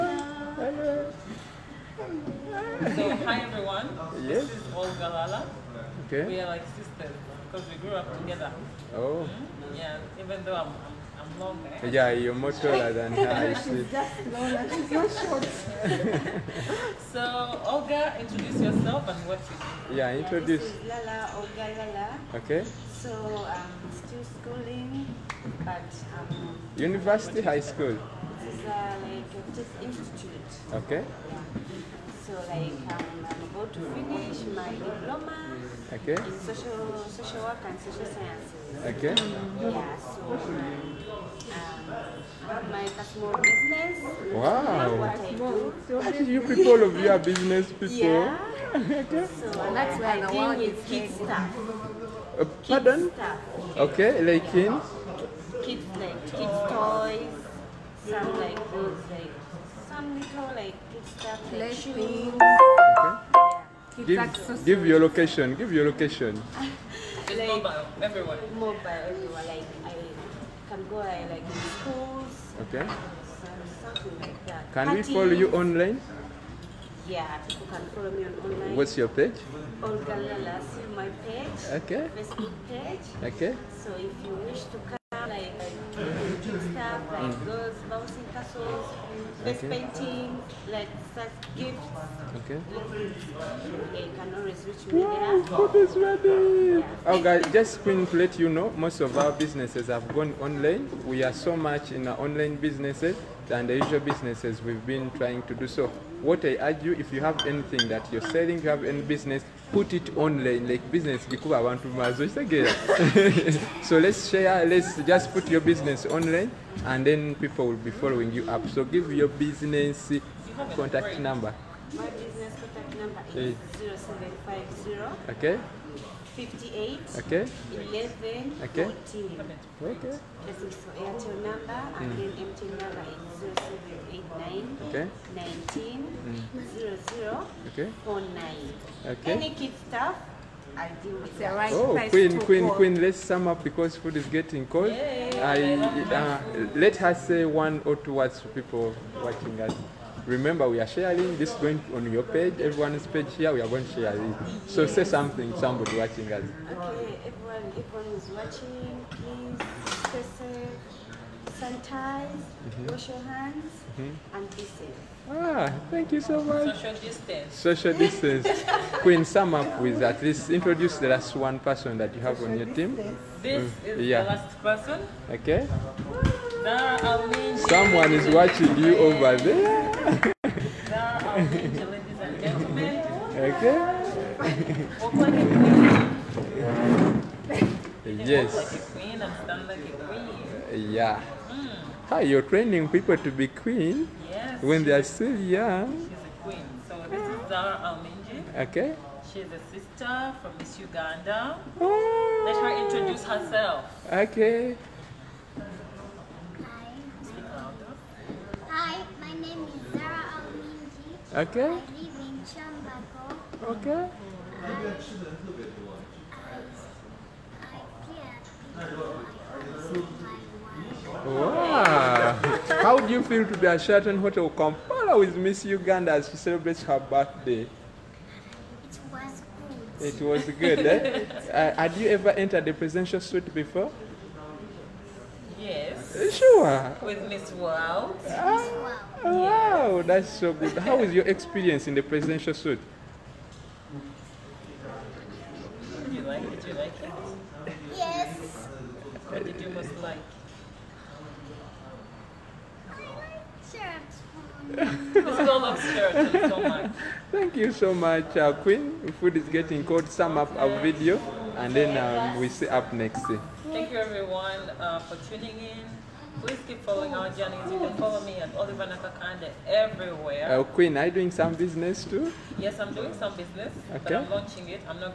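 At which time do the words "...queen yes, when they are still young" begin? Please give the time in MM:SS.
03:13.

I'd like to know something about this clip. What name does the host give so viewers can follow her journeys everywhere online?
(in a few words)
Oliver Nakakande.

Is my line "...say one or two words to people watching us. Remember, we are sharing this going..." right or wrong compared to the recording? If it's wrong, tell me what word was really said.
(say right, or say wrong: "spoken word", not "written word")
right.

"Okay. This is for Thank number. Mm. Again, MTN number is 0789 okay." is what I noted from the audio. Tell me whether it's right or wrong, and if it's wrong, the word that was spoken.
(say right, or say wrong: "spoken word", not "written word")
wrong: "Airtel", not "Thank".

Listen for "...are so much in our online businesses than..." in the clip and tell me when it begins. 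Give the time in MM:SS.
01:41.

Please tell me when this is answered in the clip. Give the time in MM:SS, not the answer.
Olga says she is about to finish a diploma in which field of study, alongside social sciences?
00:37.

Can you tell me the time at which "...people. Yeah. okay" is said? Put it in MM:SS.
00:47.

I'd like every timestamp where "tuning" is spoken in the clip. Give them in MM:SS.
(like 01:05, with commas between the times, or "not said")
04:25.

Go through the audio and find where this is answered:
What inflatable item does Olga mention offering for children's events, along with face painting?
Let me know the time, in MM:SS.
01:27.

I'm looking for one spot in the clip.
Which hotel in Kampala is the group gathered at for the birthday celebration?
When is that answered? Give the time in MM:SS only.
03:43.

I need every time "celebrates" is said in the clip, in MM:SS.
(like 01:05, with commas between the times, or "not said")
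03:46.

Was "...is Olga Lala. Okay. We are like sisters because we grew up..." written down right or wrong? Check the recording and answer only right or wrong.
right.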